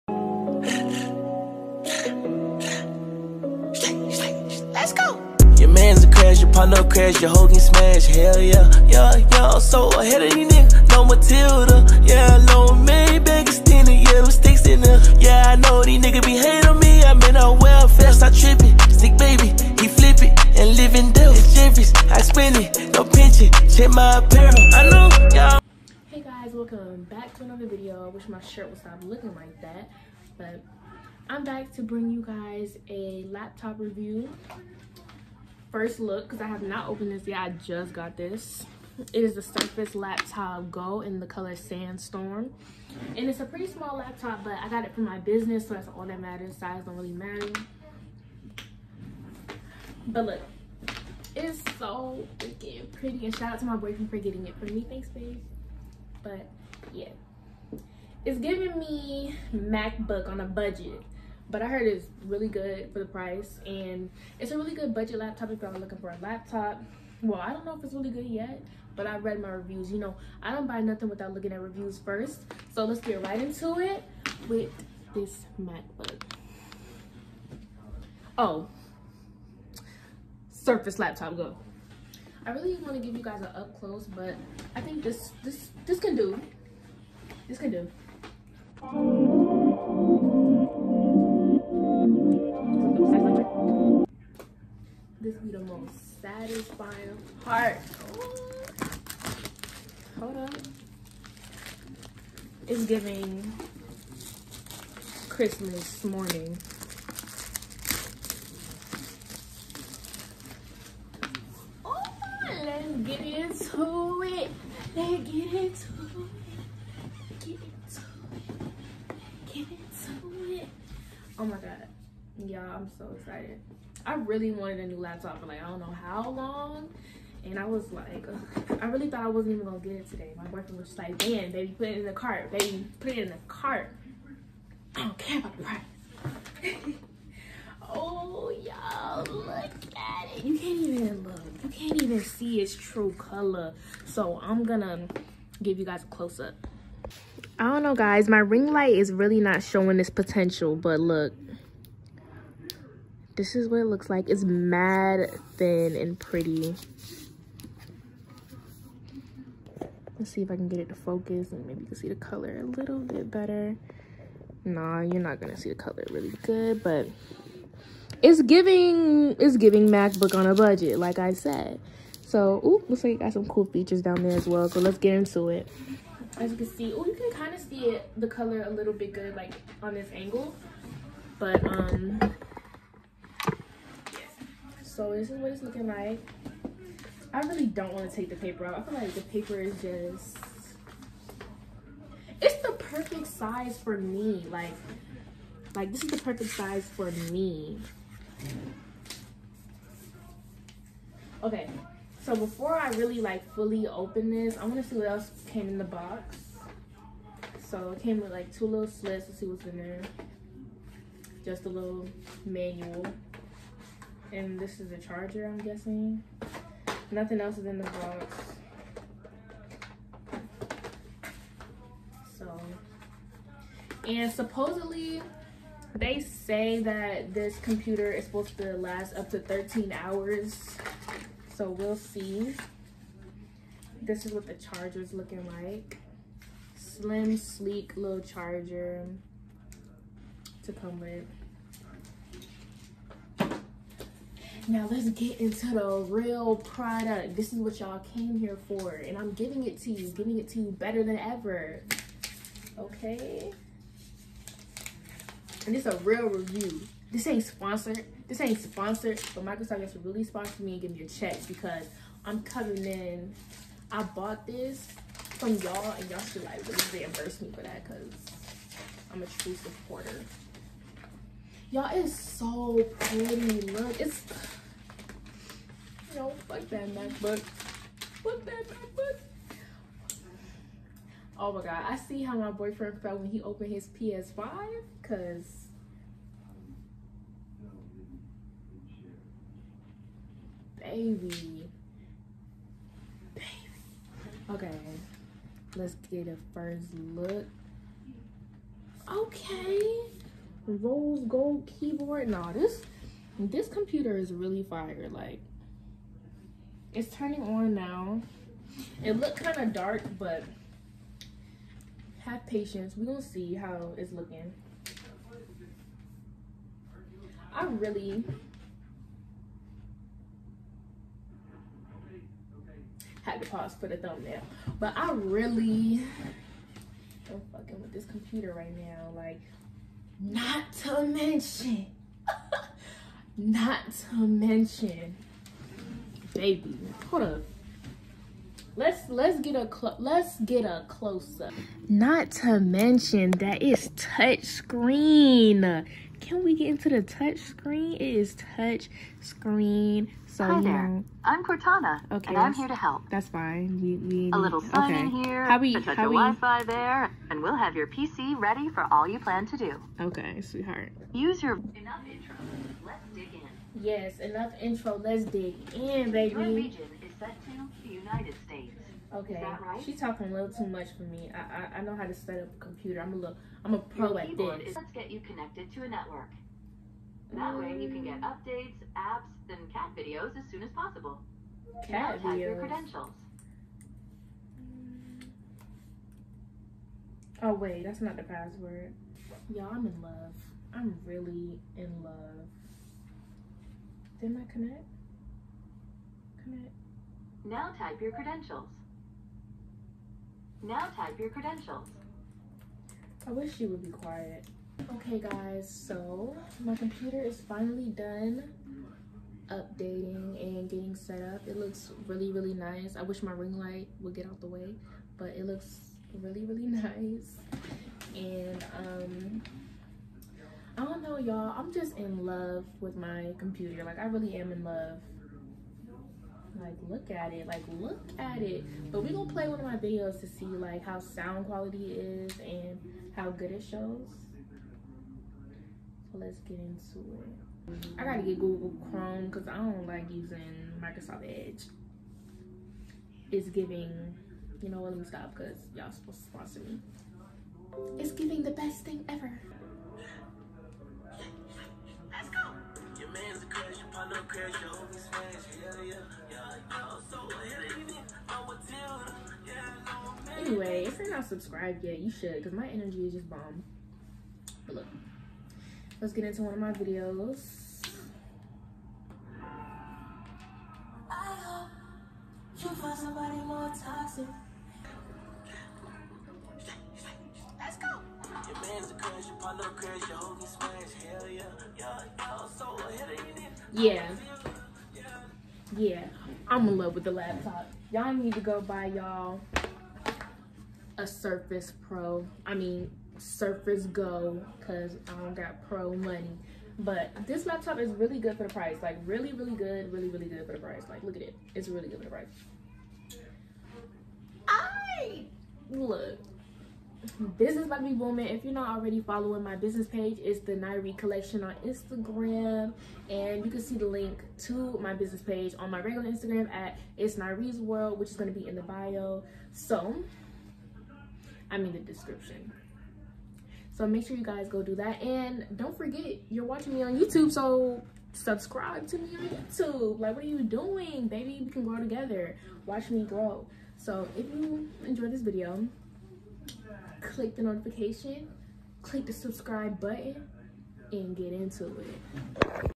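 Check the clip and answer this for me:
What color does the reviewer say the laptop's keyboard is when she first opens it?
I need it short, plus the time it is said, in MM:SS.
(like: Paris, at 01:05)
Rose gold, at 05:00.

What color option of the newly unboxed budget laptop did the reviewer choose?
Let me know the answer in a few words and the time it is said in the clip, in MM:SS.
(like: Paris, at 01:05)
Sandstone, at 00:41.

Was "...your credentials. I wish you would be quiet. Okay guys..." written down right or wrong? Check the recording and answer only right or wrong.
right.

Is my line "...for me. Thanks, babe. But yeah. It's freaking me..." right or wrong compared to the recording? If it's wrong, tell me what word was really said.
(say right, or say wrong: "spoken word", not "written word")
wrong: "giving", not "freaking".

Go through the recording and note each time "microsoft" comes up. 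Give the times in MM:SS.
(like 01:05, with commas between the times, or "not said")
04:19, 07:20.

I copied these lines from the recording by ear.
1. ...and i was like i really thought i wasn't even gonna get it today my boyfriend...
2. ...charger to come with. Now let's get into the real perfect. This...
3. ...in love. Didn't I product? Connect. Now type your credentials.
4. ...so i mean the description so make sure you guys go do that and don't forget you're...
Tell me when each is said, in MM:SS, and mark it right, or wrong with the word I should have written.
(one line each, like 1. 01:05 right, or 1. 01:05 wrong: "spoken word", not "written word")
1. 02:07 right
2. 03:58 wrong: "product", not "perfect"
3. 06:31 wrong: "connect", not "product"
4. 08:39 right.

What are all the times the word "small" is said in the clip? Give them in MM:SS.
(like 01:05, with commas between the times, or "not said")
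00:43.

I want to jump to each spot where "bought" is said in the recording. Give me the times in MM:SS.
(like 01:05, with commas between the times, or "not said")
04:24.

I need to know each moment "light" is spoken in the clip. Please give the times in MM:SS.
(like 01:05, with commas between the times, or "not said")
02:28, 06:53.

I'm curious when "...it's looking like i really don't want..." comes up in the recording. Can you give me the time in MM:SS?
03:05.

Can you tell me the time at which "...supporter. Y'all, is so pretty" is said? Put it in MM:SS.
04:29.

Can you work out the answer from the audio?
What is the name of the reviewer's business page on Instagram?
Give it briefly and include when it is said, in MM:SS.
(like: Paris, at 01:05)
The Nyree Collection, at 08:30.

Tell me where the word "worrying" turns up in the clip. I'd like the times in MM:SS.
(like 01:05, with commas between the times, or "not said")
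not said.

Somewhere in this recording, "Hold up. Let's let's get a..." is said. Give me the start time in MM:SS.
05:37.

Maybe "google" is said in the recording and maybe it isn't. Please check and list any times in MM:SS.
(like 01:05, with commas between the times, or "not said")
07:18.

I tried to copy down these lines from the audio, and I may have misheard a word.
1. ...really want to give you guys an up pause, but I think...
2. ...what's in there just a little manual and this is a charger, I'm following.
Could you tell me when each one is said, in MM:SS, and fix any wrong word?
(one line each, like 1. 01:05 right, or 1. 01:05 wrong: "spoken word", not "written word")
1. 01:22 wrong: "close", not "pause"
2. 03:29 wrong: "guessing", not "following".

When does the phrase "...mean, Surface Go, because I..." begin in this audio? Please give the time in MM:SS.
08:12.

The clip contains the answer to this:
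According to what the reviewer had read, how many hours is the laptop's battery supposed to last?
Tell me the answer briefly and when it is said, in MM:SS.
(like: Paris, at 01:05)
13, at 03:49.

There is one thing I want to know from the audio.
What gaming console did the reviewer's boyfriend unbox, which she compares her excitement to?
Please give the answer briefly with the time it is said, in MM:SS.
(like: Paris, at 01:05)
PS5, at 04:43.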